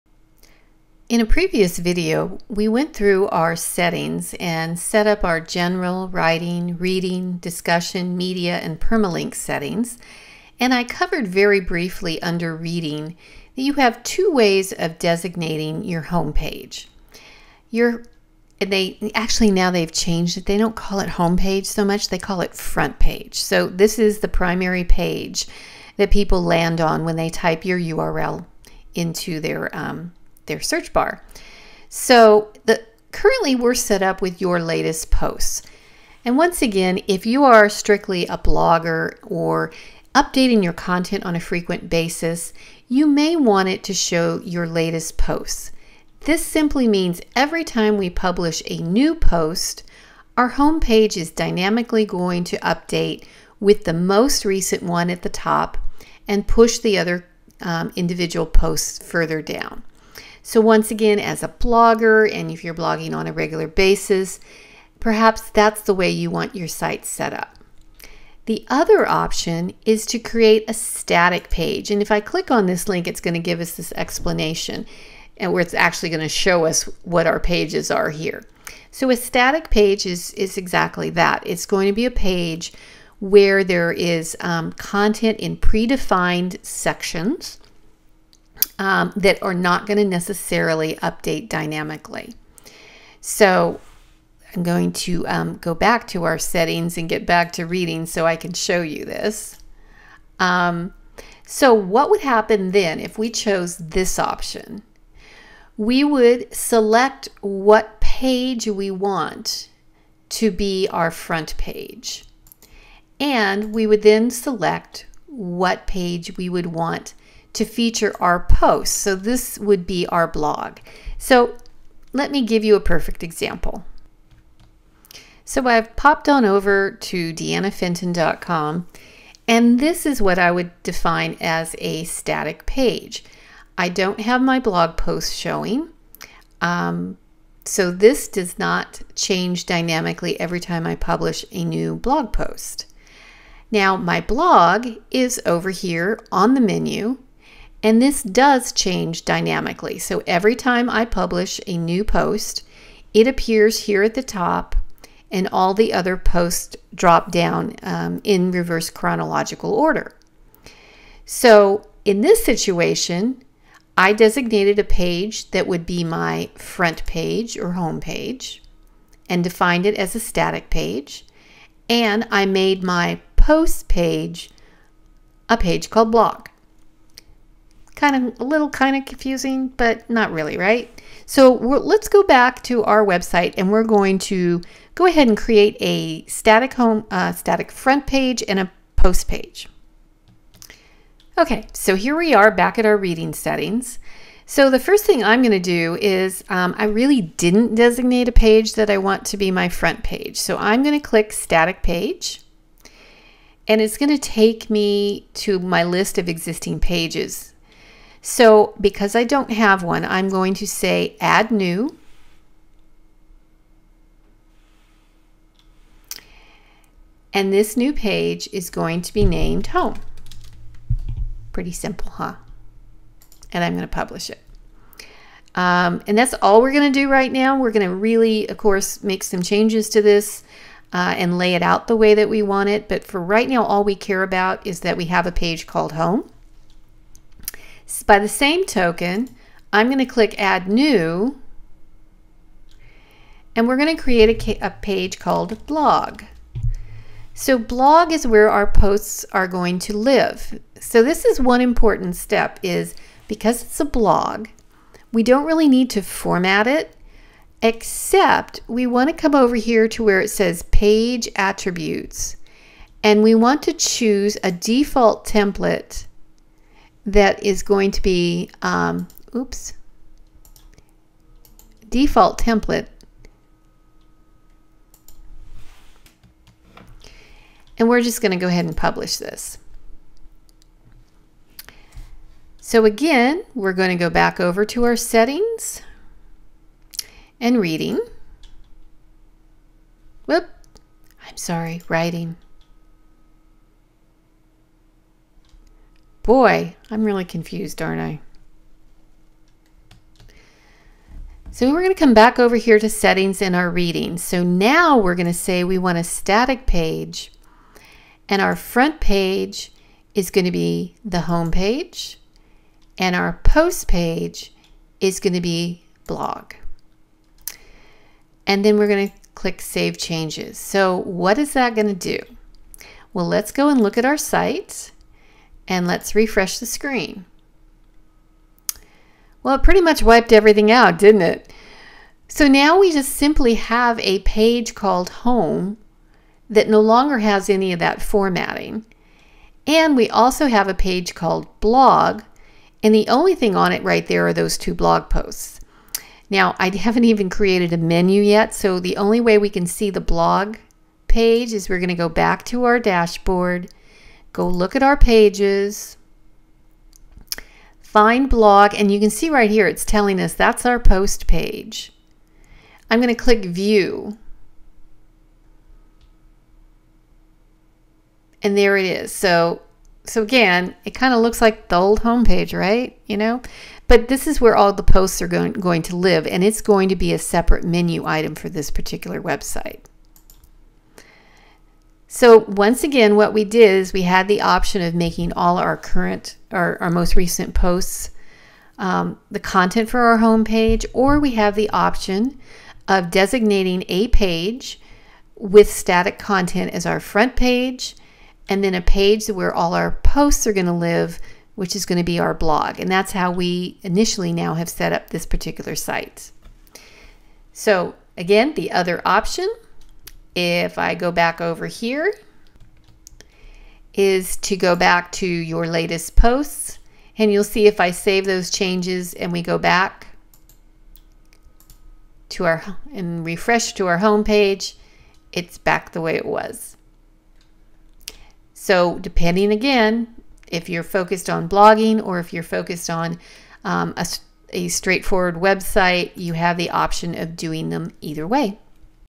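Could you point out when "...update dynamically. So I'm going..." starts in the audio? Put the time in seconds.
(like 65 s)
91 s.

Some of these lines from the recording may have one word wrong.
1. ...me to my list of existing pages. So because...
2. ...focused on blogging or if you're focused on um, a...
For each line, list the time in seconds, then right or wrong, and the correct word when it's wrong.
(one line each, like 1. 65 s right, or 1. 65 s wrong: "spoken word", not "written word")
1. 204 s right
2. 430 s right.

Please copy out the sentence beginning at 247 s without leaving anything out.
So blog is where our posts are going to live.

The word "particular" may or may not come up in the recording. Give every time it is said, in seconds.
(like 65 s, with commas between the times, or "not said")
378 s, 405 s.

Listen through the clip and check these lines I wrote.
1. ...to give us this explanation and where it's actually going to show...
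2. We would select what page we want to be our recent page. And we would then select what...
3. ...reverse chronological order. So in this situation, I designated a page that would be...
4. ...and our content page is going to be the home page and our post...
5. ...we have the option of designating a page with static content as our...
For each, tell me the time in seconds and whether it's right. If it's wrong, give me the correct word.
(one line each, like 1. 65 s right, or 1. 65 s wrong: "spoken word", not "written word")
1. 73 s right
2. 105 s wrong: "front", not "recent"
3. 158 s right
4. 308 s wrong: "front", not "content"
5. 391 s right.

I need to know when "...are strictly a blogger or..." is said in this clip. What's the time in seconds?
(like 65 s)
37 s.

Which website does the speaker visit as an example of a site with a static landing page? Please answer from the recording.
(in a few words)
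DeannaFenton.com.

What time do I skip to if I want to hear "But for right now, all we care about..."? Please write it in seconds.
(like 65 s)
232 s.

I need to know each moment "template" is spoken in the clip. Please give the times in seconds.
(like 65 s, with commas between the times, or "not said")
265 s, 272 s.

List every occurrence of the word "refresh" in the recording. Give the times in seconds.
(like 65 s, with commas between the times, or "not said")
326 s, 423 s.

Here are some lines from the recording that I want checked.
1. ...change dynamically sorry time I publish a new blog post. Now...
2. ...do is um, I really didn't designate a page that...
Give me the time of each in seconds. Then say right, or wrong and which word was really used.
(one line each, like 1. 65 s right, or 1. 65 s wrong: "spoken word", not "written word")
1. 139 s wrong: "every", not "sorry"
2. 195 s right.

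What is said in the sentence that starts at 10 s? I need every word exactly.
And I covered very briefly under reading that you have two ways of designating your home page.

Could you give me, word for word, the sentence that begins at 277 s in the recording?
And we're just going to go ahead and publish this.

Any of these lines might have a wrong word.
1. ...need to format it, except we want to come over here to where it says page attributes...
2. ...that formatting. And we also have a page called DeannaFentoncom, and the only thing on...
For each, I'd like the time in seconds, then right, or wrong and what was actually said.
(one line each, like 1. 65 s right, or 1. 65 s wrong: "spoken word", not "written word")
1. 255 s right
2. 337 s wrong: "Blog", not "DeannaFentoncom".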